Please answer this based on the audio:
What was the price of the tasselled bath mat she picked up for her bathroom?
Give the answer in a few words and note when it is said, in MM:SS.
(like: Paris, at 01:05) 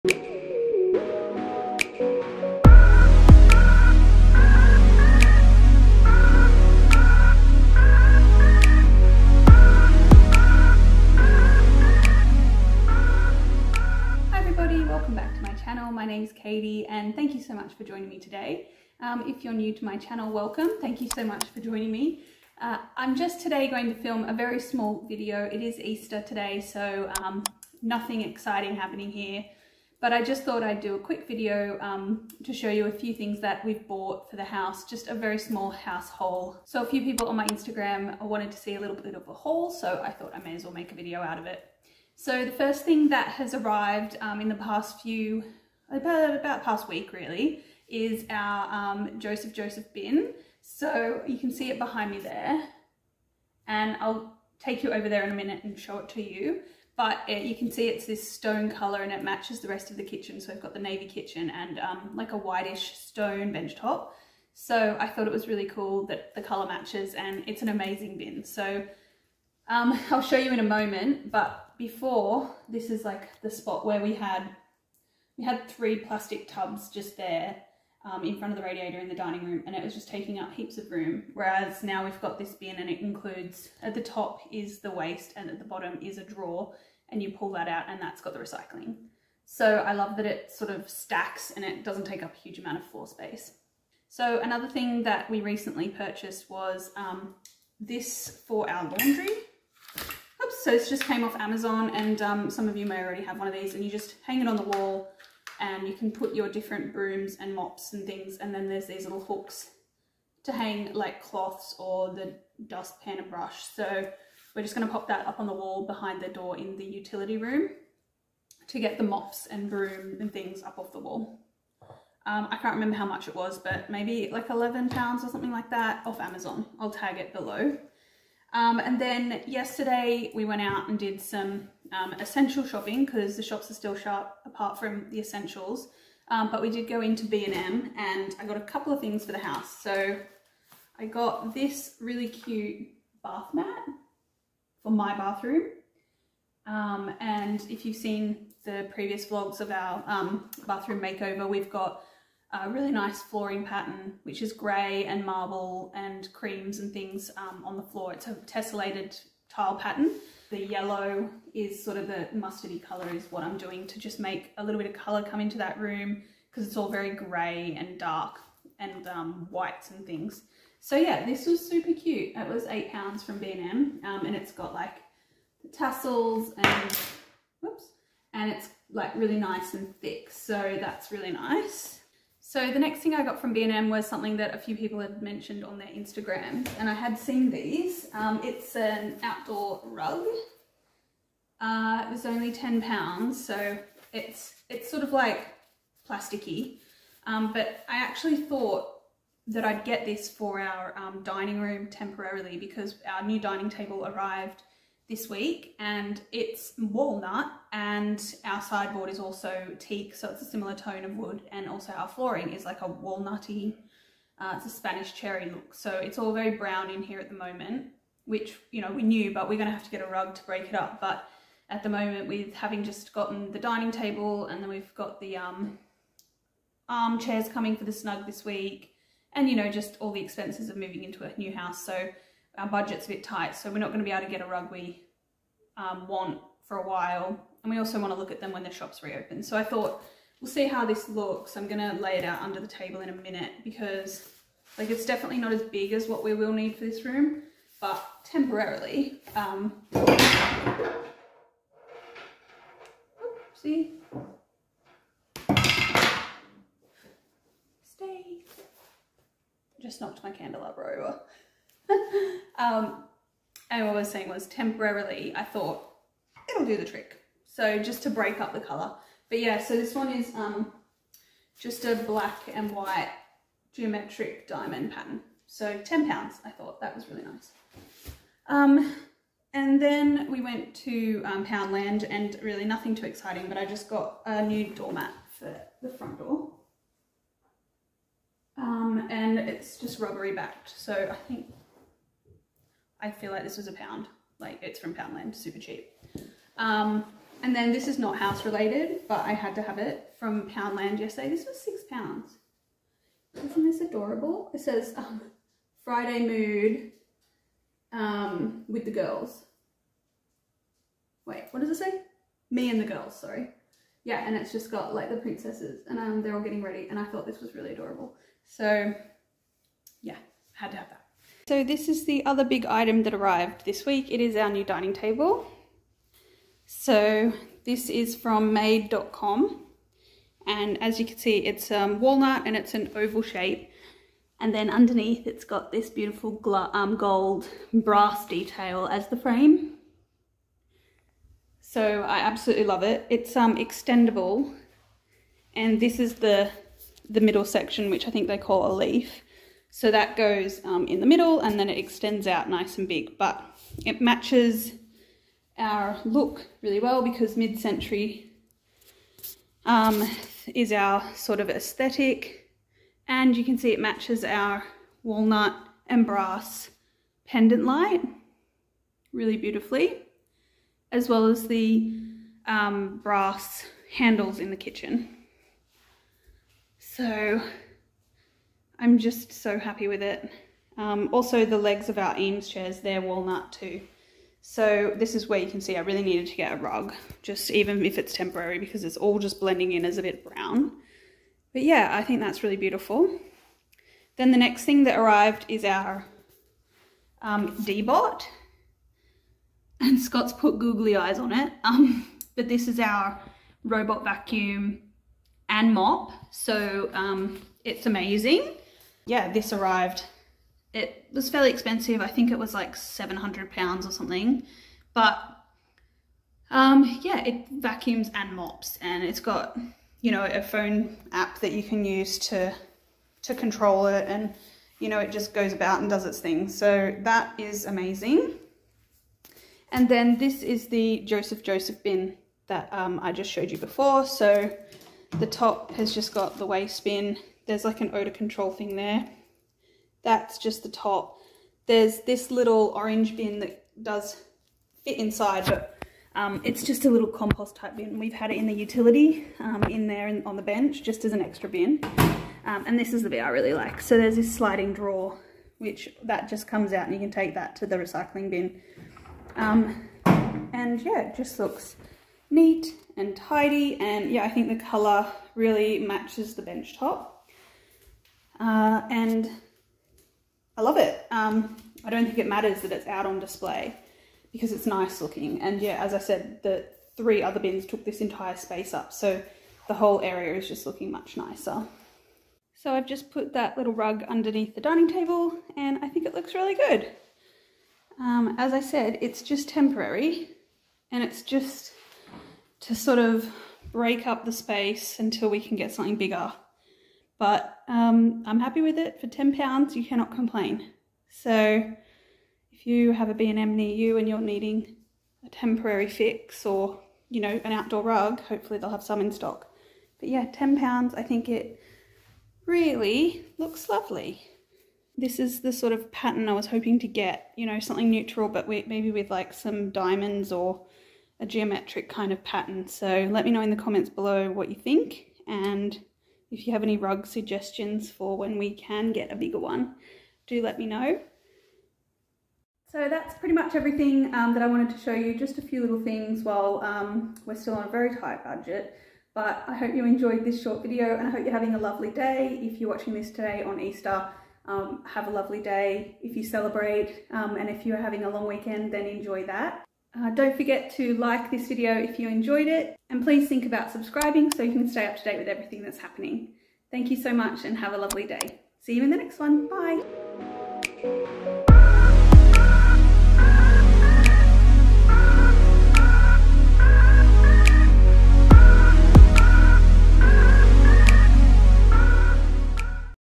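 8 pounds, at 02:52.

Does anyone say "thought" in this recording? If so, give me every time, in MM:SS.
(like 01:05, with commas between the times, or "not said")
00:30, 00:40, 01:05, 03:18, 03:59, 04:25, 04:36, 05:17.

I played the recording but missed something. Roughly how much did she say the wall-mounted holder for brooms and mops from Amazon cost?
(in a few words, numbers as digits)
11 pounds.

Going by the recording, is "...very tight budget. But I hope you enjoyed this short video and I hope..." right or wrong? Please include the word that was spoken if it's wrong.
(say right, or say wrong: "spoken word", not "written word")
right.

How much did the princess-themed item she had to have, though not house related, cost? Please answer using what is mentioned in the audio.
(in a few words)
6 pounds.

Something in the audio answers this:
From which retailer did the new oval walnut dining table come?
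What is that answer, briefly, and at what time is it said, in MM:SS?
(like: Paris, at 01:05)
made.com, at 05:28.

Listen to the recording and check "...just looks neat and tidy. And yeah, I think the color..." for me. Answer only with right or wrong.
right.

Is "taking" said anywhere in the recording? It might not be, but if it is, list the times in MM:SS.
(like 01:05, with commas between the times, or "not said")
01:20.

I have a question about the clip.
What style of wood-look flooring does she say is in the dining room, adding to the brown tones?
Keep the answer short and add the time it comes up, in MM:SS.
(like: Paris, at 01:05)
Spanish cherry, at 03:34.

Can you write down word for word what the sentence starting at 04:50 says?
So I think I feel like this was a pound.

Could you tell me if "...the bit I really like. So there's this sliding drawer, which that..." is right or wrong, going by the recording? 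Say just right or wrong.
right.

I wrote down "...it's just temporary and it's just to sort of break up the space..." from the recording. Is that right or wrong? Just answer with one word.
right.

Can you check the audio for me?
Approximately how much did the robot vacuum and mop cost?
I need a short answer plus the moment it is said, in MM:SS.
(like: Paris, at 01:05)
700 pounds, at 06:52.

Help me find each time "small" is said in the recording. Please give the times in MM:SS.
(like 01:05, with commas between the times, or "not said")
00:24, 00:35.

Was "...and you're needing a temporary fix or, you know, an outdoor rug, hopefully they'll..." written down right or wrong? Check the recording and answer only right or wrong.
right.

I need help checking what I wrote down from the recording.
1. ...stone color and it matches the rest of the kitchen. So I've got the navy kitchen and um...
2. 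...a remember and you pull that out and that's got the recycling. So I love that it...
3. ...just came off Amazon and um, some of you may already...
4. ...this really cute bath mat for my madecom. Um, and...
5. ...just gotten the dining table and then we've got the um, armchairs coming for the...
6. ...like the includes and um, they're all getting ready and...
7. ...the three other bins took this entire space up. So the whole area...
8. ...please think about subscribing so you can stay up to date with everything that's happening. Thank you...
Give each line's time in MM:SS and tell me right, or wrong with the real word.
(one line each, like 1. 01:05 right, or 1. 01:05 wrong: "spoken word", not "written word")
1. 00:58 right
2. 01:26 wrong: "drawer", not "remember"
3. 01:40 right
4. 02:21 wrong: "bathroom", not "madecom"
5. 03:42 right
6. 05:14 wrong: "princesses", not "includes"
7. 07:56 right
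8. 09:13 right.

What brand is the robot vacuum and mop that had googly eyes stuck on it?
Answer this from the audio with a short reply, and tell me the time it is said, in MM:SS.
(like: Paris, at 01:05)
Deebot, at 06:37.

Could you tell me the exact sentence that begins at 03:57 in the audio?
And we also want to look at them when the shops reopen.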